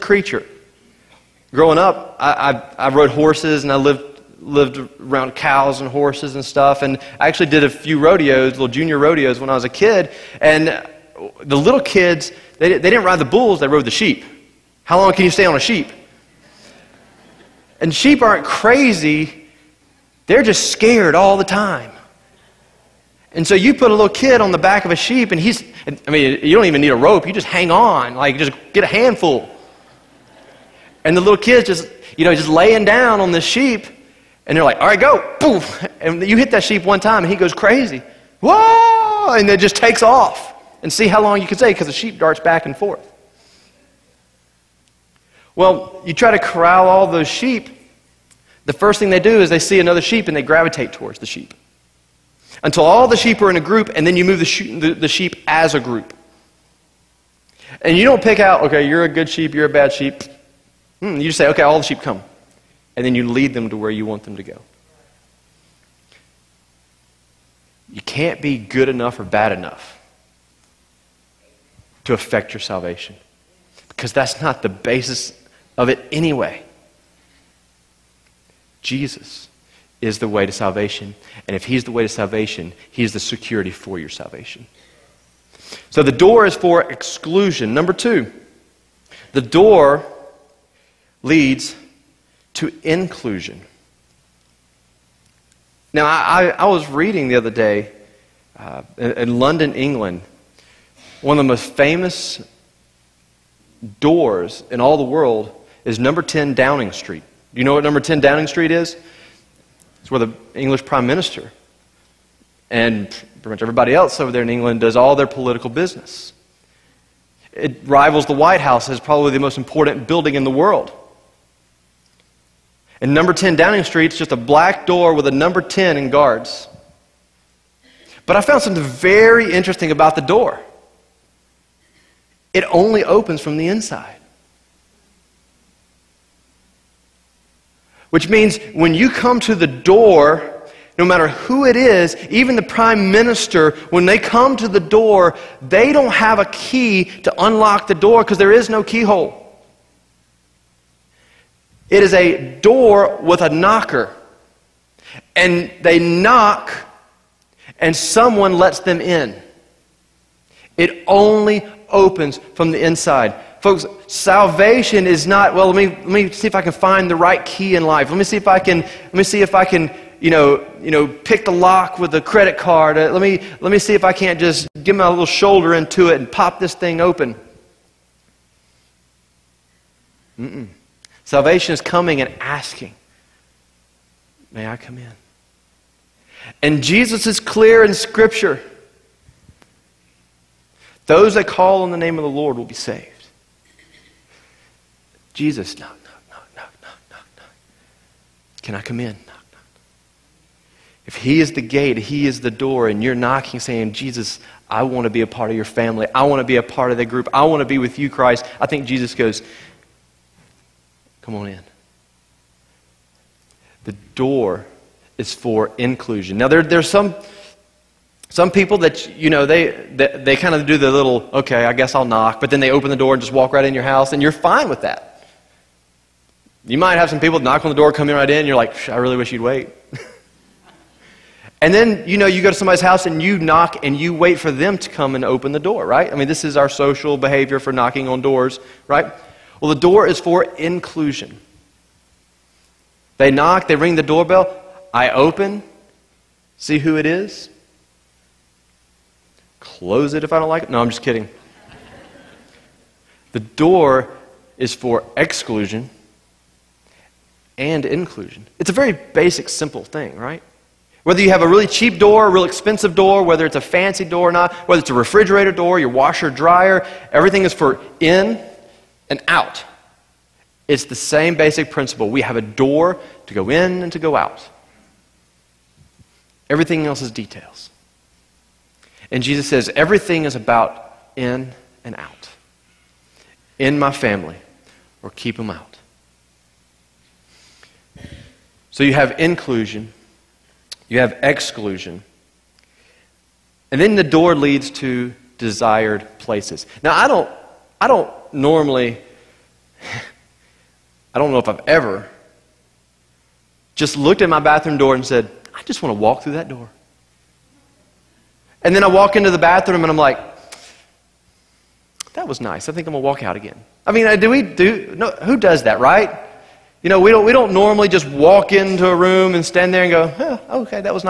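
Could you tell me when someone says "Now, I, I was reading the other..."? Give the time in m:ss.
1:35.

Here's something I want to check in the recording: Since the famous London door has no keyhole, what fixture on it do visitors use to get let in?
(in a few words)
A knocker.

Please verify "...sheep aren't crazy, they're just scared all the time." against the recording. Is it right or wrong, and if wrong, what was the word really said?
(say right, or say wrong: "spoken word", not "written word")
right.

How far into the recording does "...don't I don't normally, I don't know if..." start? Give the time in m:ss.
4:57.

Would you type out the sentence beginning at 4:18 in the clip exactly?
It's a very basic, simple thing, right?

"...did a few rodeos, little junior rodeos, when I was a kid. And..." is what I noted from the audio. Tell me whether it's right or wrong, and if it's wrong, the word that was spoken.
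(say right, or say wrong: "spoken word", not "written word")
right.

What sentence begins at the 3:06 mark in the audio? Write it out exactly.
And Jesus is clear in Scripture those that call on the name of the Lord will be saved.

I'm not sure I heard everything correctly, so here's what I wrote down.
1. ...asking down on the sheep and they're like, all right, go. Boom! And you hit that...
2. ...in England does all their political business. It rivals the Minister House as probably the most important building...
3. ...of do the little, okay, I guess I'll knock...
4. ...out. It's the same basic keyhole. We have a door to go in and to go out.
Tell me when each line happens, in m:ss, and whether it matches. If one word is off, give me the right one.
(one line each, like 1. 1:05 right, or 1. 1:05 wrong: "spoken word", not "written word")
1. 0:32 wrong: "laying", not "asking"
2. 1:54 wrong: "White", not "Minister"
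3. 3:40 right
4. 4:29 wrong: "principle", not "keyhole".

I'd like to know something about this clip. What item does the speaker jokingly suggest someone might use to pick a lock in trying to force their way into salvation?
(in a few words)
A credit card.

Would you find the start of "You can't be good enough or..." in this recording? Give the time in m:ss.
1:07.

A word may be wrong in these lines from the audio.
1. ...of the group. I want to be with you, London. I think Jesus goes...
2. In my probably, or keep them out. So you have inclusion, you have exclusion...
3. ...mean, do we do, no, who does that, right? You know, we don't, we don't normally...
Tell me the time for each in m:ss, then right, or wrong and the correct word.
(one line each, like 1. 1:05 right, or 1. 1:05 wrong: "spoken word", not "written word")
1. 3:26 wrong: "Christ", not "London"
2. 4:43 wrong: "family", not "probably"
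3. 5:13 right.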